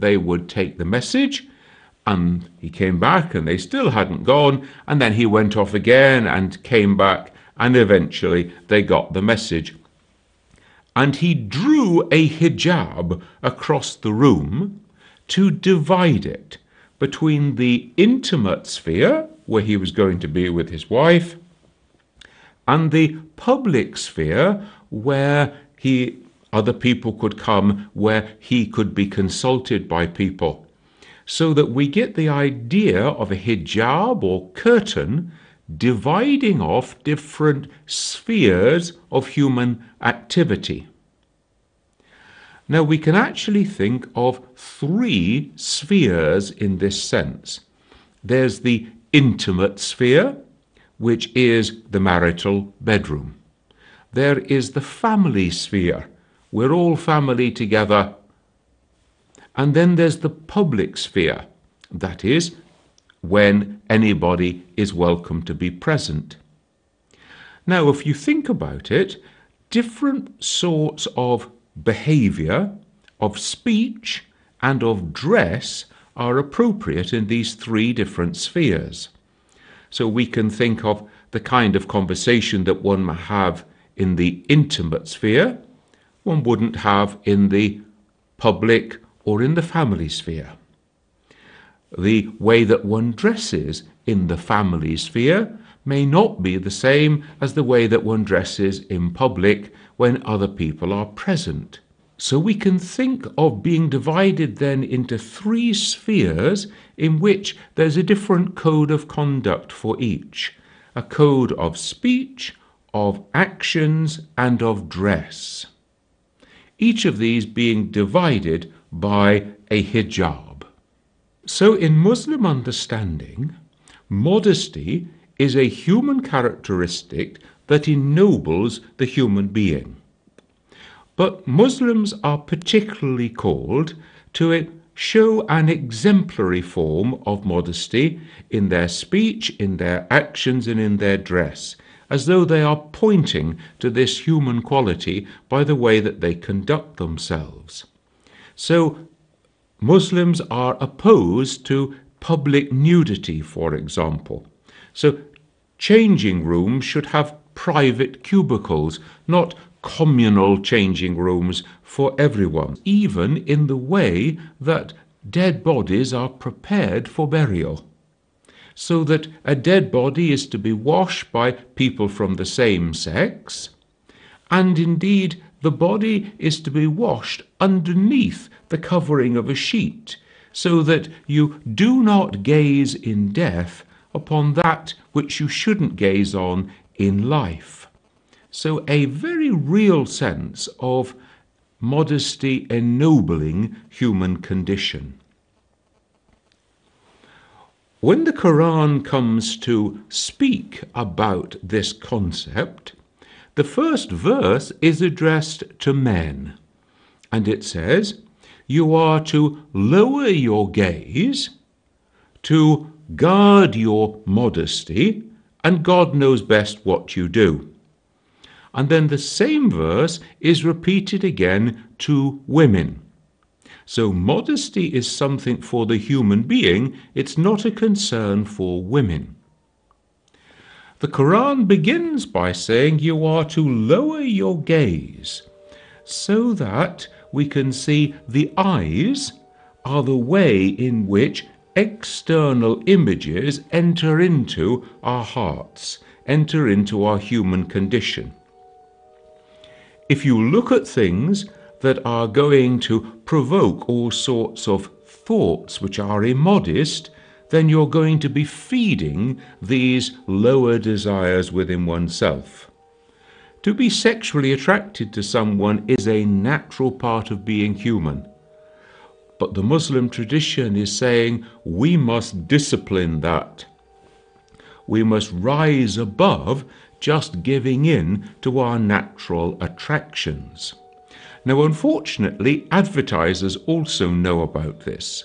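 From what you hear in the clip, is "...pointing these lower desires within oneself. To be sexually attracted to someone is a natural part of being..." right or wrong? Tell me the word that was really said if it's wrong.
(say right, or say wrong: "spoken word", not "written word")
wrong: "feeding", not "pointing".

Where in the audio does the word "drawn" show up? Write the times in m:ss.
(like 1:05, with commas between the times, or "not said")
not said.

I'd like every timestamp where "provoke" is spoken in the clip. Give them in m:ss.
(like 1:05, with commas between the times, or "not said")
4:13.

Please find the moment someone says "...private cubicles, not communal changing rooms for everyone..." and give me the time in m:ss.
2:37.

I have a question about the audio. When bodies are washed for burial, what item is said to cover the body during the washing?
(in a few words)
a sheet.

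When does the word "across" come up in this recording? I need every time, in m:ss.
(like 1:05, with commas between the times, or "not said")
0:13.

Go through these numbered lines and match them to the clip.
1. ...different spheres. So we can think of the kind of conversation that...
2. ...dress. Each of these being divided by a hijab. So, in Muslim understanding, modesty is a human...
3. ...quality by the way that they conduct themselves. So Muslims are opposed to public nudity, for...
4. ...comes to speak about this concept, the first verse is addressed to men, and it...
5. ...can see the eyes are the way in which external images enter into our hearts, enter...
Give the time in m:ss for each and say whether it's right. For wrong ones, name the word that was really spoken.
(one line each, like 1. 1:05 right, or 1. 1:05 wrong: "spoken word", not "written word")
1. 1:17 right
2. 1:54 right
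3. 2:24 right
4. 3:19 right
5. 3:57 right.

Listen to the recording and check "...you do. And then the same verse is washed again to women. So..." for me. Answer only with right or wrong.
wrong.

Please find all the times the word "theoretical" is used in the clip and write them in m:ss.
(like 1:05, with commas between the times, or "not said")
not said.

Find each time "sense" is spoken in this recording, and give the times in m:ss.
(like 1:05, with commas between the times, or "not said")
0:47, 3:10.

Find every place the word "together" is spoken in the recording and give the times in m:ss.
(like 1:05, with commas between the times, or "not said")
0:57.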